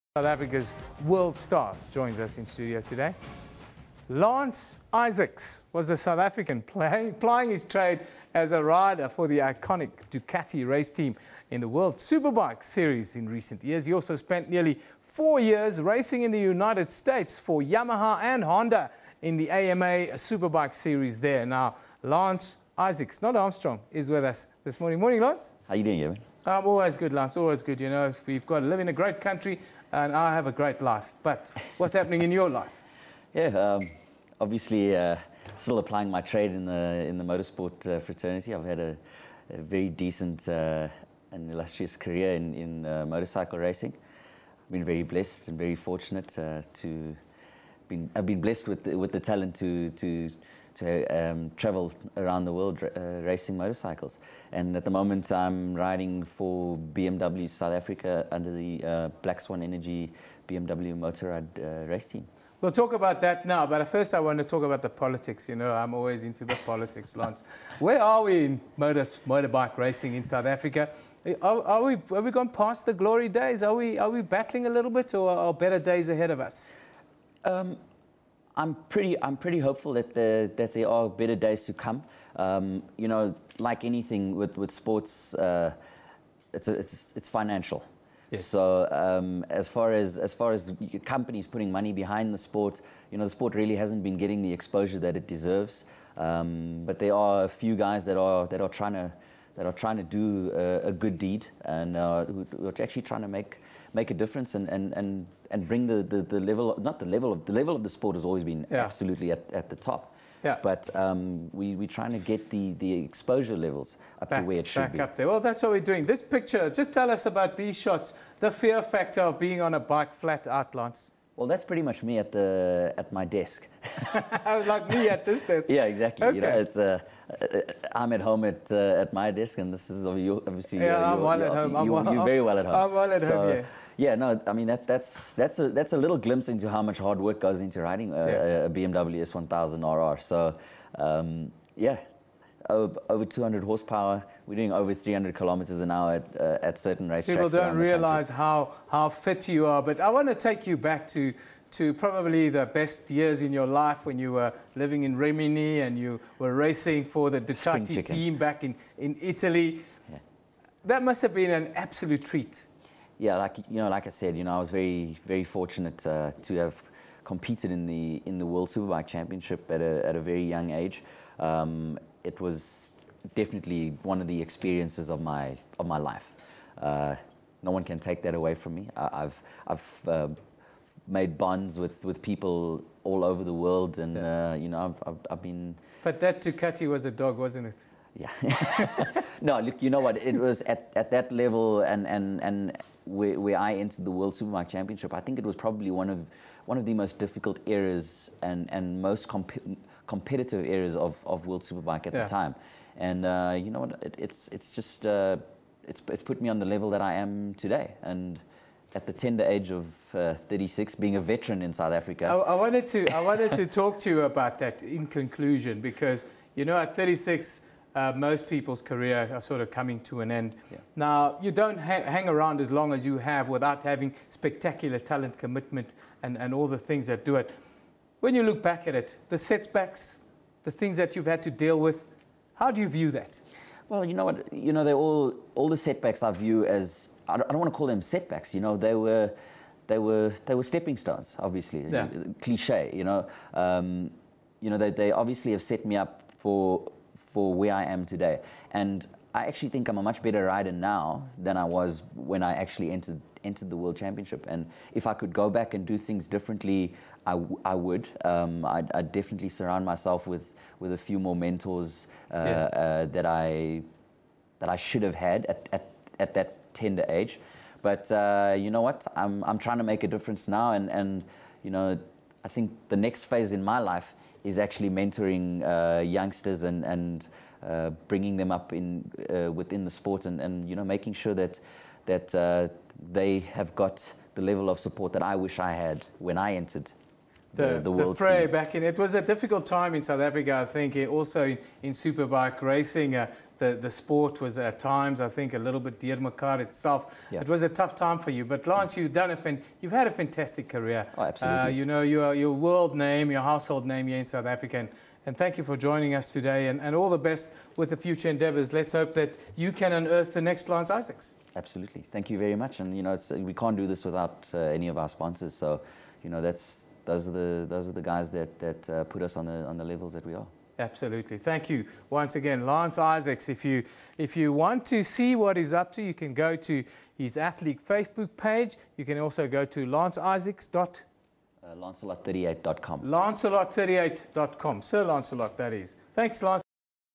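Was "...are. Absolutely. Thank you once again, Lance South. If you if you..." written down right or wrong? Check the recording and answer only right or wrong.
wrong.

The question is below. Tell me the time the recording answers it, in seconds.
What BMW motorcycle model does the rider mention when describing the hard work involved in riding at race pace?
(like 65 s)
138 s.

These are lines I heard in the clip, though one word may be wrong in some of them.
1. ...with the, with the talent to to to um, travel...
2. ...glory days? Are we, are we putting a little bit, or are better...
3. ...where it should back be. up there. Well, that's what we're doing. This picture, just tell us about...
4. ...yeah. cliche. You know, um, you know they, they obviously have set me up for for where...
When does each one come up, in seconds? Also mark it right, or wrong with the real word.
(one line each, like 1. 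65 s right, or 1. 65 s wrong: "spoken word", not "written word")
1. 48 s right
2. 72 s wrong: "battling", not "putting"
3. 114 s right
4. 241 s right.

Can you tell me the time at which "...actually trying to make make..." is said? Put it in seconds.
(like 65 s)
102 s.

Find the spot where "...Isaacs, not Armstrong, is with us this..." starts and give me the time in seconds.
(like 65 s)
22 s.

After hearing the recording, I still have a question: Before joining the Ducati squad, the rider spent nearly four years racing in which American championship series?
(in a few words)
AMA Superbike Series.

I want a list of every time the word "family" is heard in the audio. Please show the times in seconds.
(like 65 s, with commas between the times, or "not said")
not said.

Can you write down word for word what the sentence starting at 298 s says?
But Lance, you've done a fin- you've had a fantastic career.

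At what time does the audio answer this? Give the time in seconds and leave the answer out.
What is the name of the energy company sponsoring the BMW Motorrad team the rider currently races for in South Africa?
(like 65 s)
59 s.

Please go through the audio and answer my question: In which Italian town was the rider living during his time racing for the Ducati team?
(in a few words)
Rimini.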